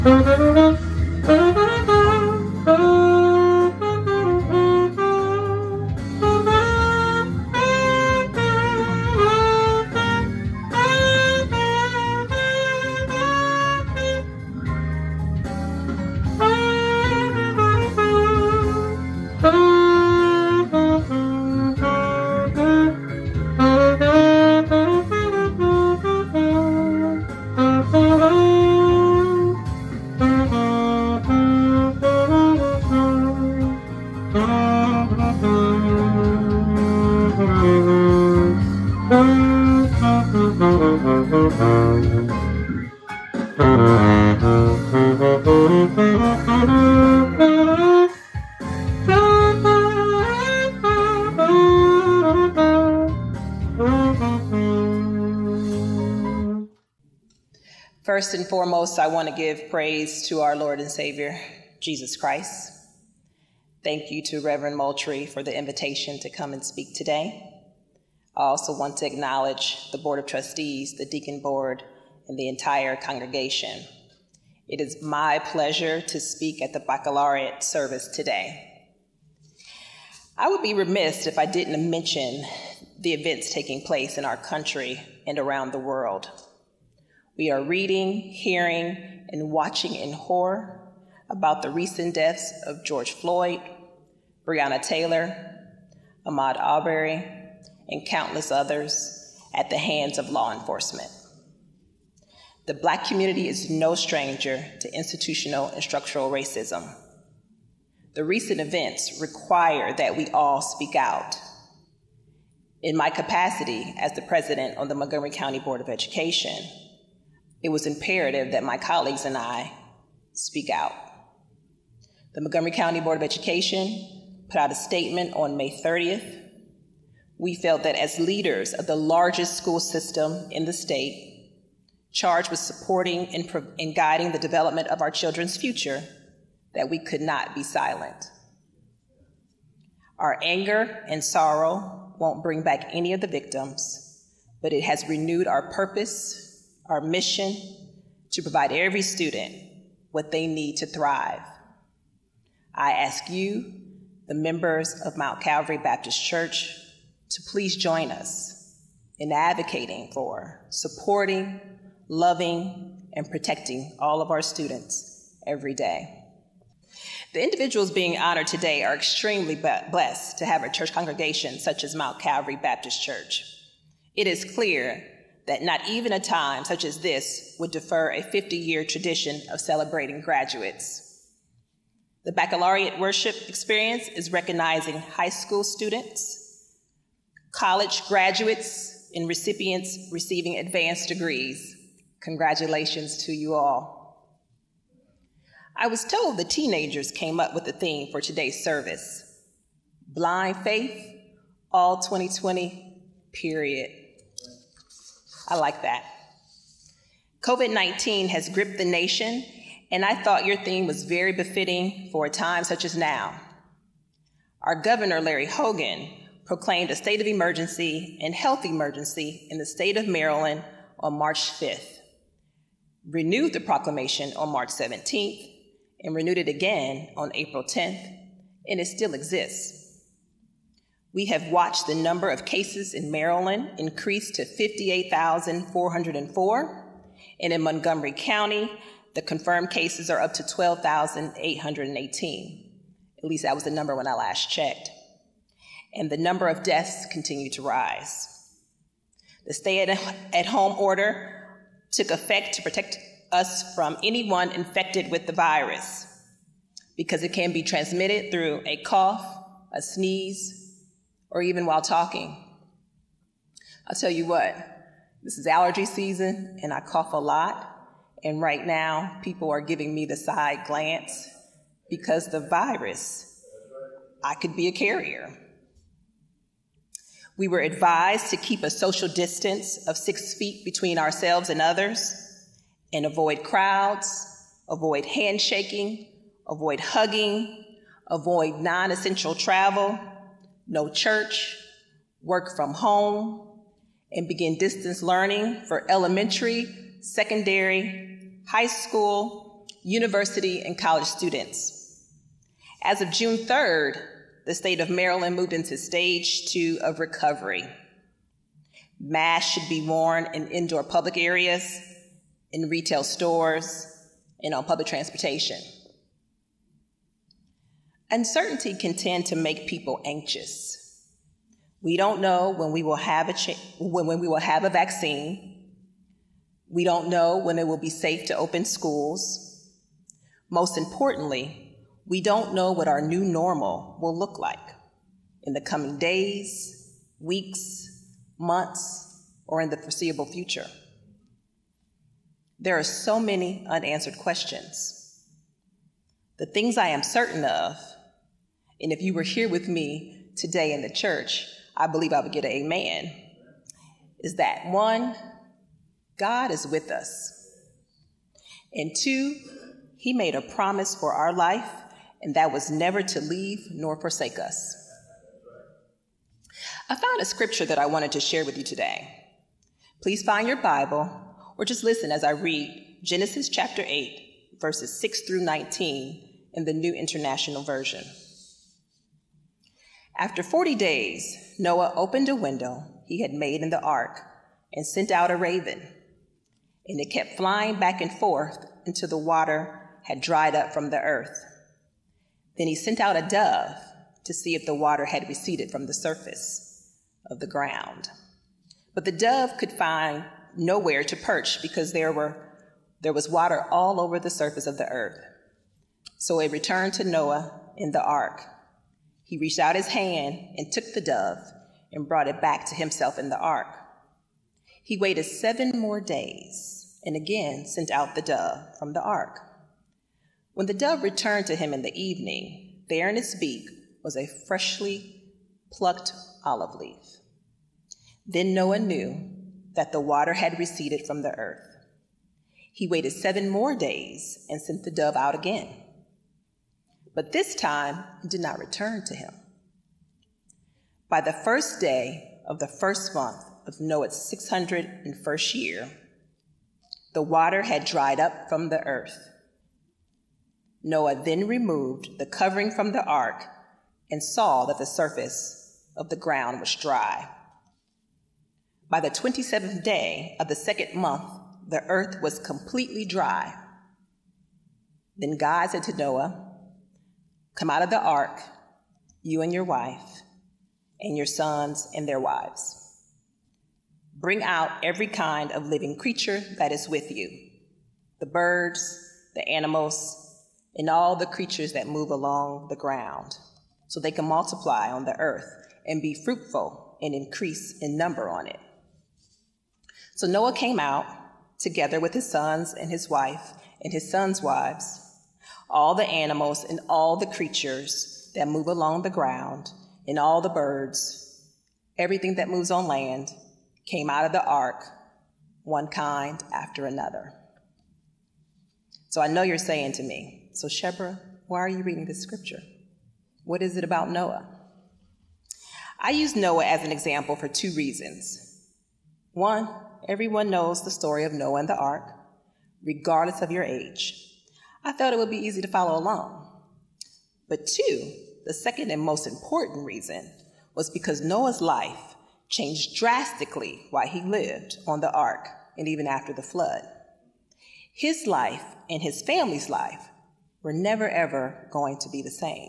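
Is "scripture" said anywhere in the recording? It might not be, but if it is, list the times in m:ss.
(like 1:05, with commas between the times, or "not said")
6:07, 8:32.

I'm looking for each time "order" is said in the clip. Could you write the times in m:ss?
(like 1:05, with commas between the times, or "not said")
4:10.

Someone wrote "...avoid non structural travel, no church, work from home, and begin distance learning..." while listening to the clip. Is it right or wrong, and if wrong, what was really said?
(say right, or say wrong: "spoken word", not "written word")
wrong: "essential", not "structural".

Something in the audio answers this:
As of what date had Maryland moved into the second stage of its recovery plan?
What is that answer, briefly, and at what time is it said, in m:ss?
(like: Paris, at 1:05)
June 3rd, at 5:03.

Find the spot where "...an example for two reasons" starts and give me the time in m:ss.
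8:36.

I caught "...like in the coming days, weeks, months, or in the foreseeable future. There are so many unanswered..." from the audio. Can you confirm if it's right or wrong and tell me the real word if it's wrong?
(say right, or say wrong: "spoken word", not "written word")
right.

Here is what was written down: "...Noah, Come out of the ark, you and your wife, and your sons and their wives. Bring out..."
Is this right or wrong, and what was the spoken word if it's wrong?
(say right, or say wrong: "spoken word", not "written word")
right.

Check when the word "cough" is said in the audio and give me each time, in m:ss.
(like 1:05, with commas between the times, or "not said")
4:18, 4:26.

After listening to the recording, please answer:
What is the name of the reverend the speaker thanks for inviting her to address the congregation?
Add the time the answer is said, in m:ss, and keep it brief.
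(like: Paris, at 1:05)
Reverend Moultrie, at 1:04.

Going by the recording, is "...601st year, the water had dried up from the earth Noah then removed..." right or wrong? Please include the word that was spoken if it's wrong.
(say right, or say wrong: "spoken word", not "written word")
right.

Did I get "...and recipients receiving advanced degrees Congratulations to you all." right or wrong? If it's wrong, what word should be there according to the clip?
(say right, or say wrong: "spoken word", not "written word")
right.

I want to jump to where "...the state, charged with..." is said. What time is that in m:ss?
2:10.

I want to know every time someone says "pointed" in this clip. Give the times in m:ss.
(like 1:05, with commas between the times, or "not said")
not said.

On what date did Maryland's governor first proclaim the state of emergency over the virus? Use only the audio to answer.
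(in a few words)
March 5th.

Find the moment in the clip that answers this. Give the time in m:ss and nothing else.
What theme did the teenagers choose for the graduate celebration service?
3:20.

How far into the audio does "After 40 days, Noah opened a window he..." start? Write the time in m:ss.
6:20.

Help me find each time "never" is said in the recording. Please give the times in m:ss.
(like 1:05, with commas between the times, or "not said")
6:02, 9:00.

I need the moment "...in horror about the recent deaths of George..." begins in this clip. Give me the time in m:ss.
1:29.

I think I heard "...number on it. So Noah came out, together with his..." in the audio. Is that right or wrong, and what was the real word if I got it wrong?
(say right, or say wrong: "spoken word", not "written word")
right.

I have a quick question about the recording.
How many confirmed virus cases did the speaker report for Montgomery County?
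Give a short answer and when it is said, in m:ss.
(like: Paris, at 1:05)
12,818, at 4:00.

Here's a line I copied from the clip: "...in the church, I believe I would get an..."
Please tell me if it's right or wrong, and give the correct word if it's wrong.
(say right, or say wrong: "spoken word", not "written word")
right.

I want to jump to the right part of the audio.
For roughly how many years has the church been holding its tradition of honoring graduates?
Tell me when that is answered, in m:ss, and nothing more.
2:58.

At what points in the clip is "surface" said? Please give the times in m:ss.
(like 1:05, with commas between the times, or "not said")
6:35, 6:44, 7:34.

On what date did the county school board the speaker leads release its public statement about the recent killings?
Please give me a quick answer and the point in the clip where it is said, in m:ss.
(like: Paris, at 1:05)
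May 30th, at 2:05.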